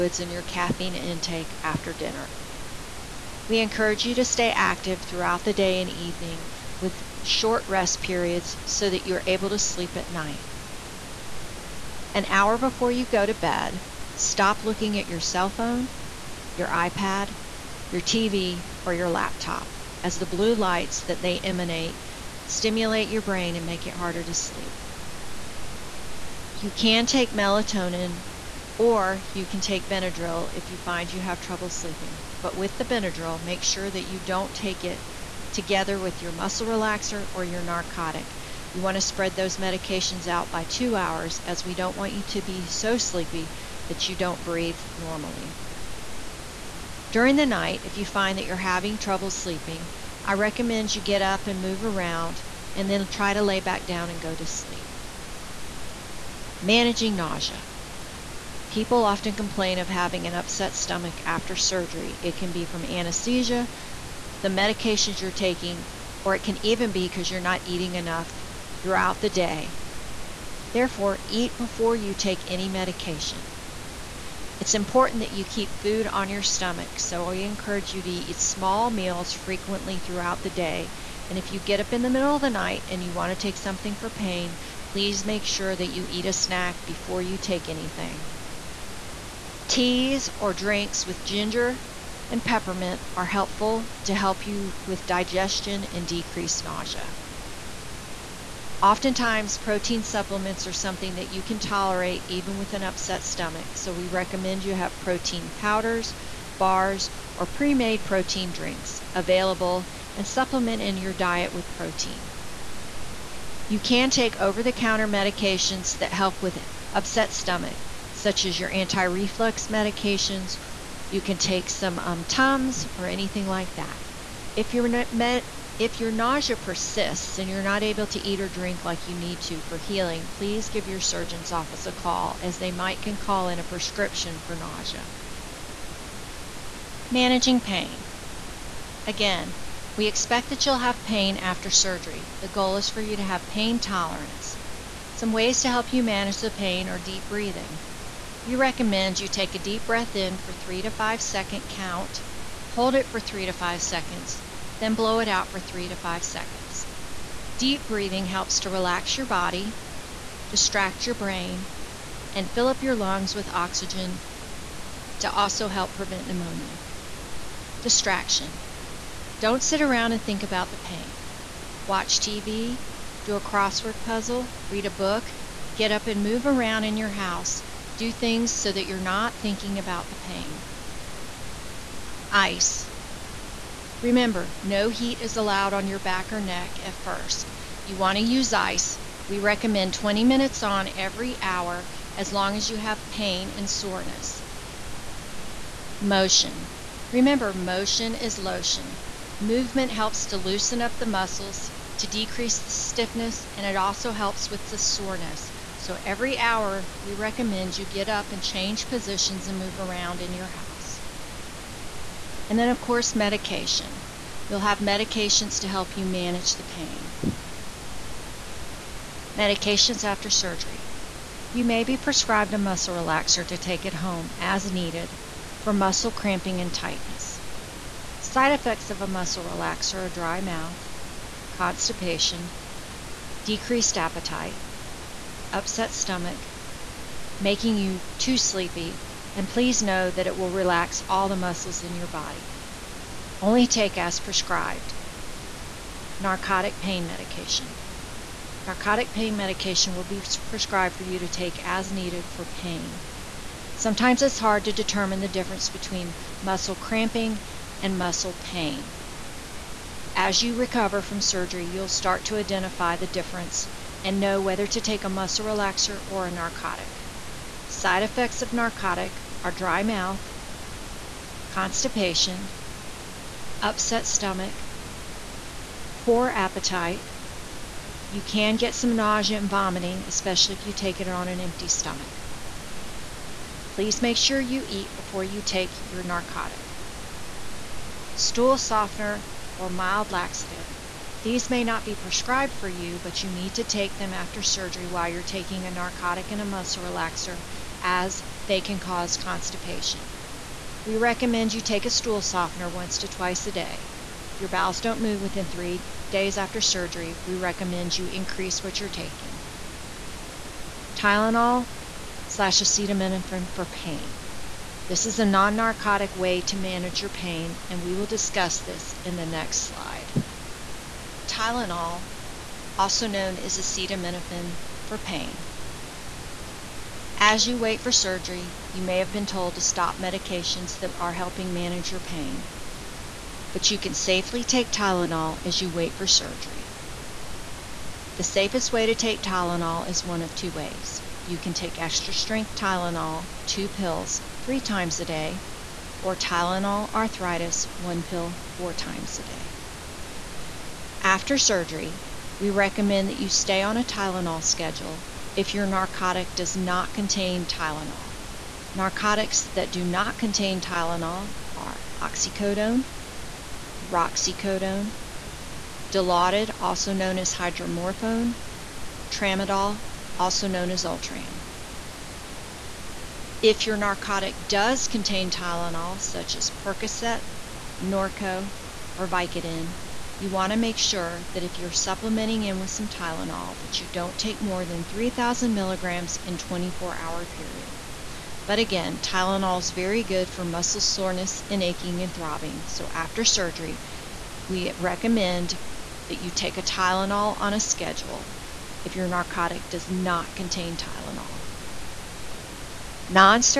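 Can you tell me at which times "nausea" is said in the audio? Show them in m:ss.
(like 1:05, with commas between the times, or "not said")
0:57, 1:36, 2:06, 2:14, 4:38.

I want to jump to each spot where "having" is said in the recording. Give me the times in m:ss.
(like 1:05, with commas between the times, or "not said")
0:48, 0:59.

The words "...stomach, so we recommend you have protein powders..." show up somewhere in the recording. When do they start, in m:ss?
1:43.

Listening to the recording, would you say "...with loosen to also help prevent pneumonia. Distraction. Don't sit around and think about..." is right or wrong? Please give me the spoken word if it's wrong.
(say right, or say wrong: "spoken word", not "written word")
wrong: "oxygen", not "loosen".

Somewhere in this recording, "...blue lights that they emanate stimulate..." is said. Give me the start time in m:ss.
0:20.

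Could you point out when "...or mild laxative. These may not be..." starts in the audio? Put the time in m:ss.
4:49.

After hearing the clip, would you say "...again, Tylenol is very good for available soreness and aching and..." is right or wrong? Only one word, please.
wrong.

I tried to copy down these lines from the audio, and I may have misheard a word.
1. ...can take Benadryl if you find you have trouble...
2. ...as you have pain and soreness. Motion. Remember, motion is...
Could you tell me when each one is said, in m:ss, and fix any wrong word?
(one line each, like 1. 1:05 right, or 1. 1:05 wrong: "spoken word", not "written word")
1. 0:29 right
2. 3:12 right.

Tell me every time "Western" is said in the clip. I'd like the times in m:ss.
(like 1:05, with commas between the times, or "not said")
not said.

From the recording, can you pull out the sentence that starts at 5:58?
Narcotics that do not contain Tylenol are oxycodone, roxicodone, Dilaudid, also known as hydromorphone, tramadol, also known as Ultram.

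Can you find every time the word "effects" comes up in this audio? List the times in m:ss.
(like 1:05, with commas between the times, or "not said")
3:48, 4:28.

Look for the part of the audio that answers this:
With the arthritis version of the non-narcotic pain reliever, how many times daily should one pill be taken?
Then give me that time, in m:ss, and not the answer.
5:48.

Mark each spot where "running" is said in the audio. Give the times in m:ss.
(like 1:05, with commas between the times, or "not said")
not said.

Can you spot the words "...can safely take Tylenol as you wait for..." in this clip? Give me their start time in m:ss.
5:33.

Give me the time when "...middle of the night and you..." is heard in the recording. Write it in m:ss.
1:22.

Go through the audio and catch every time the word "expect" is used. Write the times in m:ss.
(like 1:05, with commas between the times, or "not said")
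2:20.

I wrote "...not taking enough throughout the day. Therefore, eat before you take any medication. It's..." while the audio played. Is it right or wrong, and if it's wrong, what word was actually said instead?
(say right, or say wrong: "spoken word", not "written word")
wrong: "eating", not "taking".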